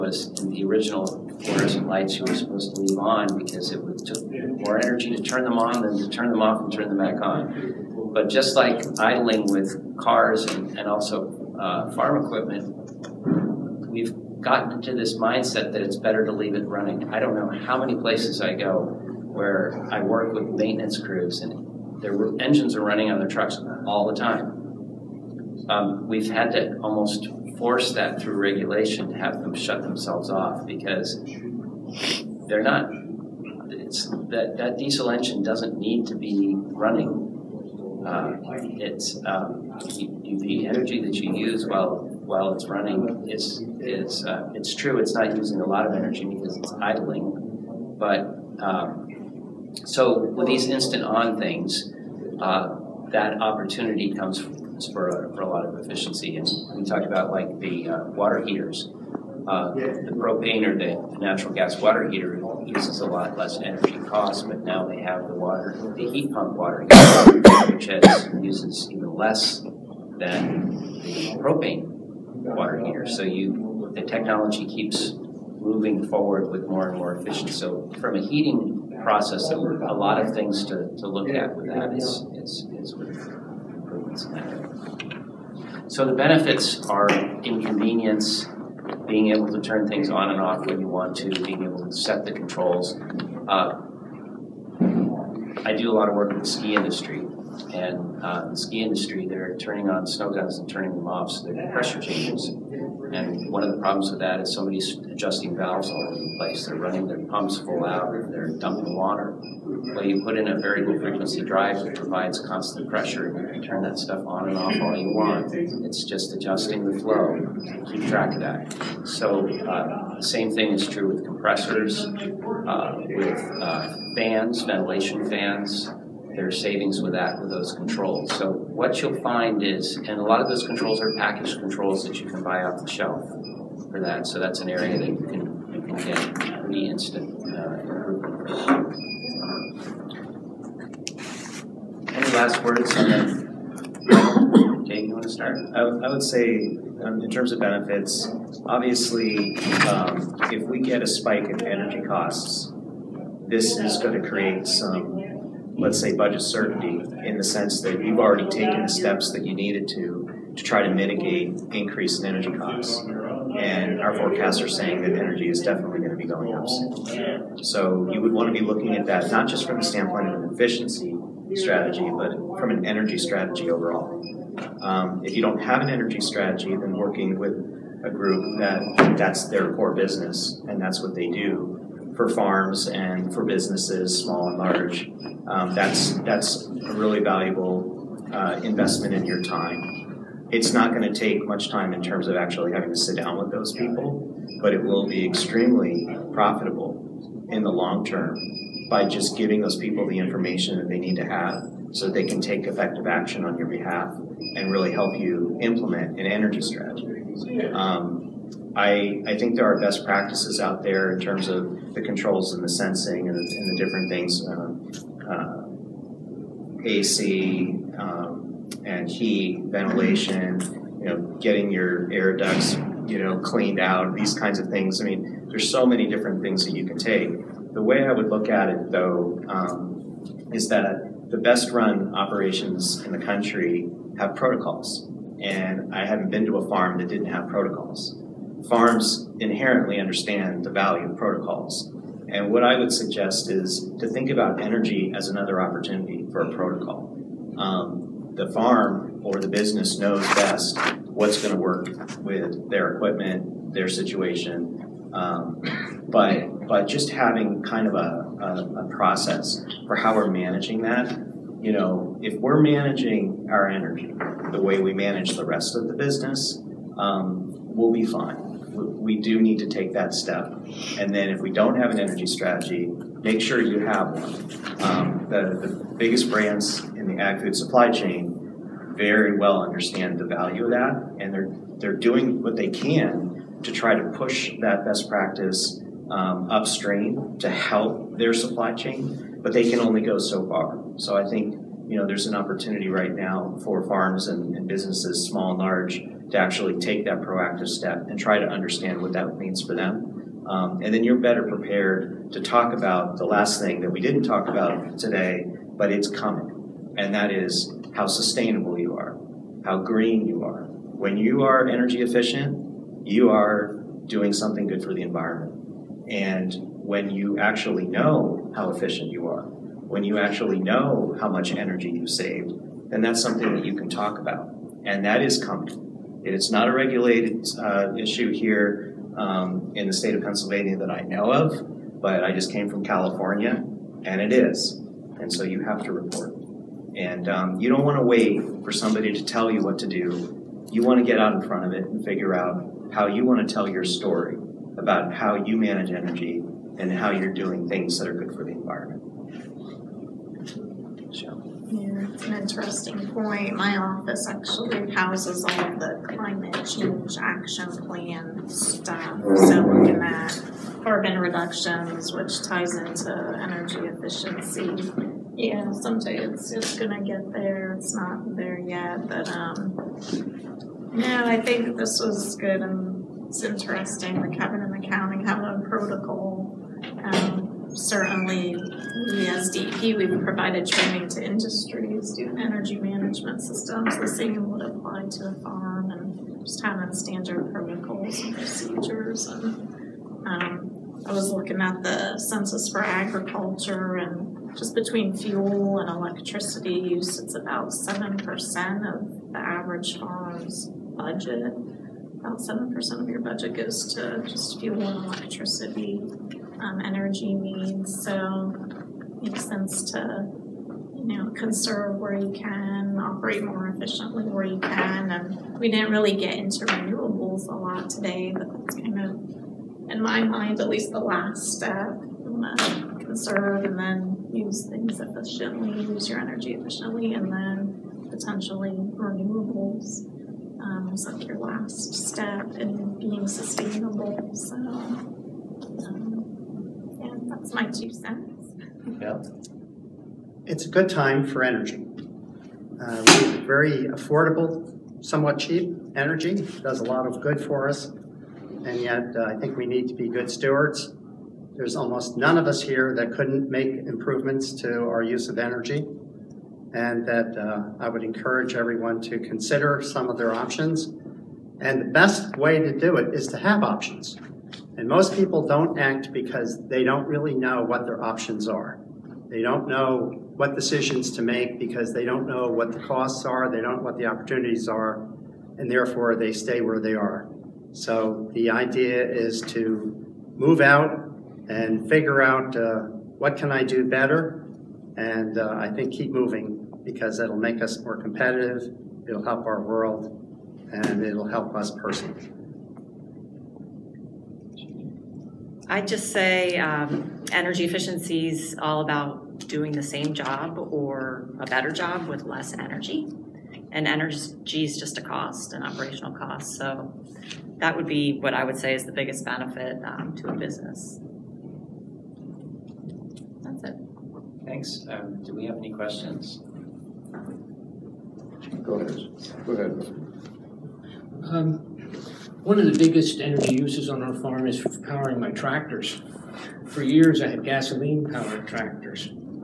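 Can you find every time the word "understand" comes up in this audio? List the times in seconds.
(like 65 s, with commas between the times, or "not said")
239 s, 279 s, 298 s.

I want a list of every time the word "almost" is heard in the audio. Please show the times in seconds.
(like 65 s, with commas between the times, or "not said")
26 s, 451 s.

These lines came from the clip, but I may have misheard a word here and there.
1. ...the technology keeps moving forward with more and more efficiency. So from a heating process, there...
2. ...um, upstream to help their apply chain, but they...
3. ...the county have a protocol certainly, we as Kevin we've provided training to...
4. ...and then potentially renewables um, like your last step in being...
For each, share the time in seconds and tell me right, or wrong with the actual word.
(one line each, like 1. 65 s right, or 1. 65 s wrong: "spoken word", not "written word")
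1. 73 s right
2. 286 s wrong: "supply", not "apply"
3. 374 s wrong: "DEP", not "Kevin"
4. 427 s right.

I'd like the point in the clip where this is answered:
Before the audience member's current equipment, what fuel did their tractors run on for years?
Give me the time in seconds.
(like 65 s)
527 s.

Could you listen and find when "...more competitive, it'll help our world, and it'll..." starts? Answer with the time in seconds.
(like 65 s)
487 s.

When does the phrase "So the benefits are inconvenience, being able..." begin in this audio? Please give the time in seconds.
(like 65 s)
85 s.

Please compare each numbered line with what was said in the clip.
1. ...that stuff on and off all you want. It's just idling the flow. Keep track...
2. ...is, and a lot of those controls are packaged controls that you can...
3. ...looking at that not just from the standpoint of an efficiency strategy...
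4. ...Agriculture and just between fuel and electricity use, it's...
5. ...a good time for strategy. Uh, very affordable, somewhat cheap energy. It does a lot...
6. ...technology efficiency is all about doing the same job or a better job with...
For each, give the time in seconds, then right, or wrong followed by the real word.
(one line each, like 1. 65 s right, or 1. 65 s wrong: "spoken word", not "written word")
1. 113 s wrong: "adjusting", not "idling"
2. 129 s right
3. 168 s right
4. 392 s right
5. 440 s wrong: "energy", not "strategy"
6. 497 s wrong: "energy", not "technology".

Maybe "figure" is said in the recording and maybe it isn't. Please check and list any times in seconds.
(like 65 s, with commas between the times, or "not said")
342 s, 481 s.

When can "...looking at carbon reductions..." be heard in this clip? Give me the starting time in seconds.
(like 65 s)
359 s.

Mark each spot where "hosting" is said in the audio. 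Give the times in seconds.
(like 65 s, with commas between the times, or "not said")
not said.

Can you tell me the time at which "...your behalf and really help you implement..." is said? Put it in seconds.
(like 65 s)
203 s.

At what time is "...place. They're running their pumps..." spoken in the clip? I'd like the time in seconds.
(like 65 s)
106 s.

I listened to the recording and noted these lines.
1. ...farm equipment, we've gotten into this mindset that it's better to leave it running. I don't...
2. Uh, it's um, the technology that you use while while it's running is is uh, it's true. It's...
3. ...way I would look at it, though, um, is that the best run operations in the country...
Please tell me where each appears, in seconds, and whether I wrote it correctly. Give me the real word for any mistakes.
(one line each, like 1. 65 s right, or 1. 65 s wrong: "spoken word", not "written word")
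1. 11 s right
2. 38 s wrong: "energy", not "technology"
3. 227 s right.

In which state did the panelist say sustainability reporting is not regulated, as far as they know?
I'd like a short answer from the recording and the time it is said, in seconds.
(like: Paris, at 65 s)
Pennsylvania, at 330 s.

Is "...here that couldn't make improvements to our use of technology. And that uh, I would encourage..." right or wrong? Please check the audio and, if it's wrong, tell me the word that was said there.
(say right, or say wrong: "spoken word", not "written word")
wrong: "energy", not "technology".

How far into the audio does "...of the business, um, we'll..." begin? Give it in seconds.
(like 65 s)
265 s.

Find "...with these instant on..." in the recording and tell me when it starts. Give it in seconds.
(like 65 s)
50 s.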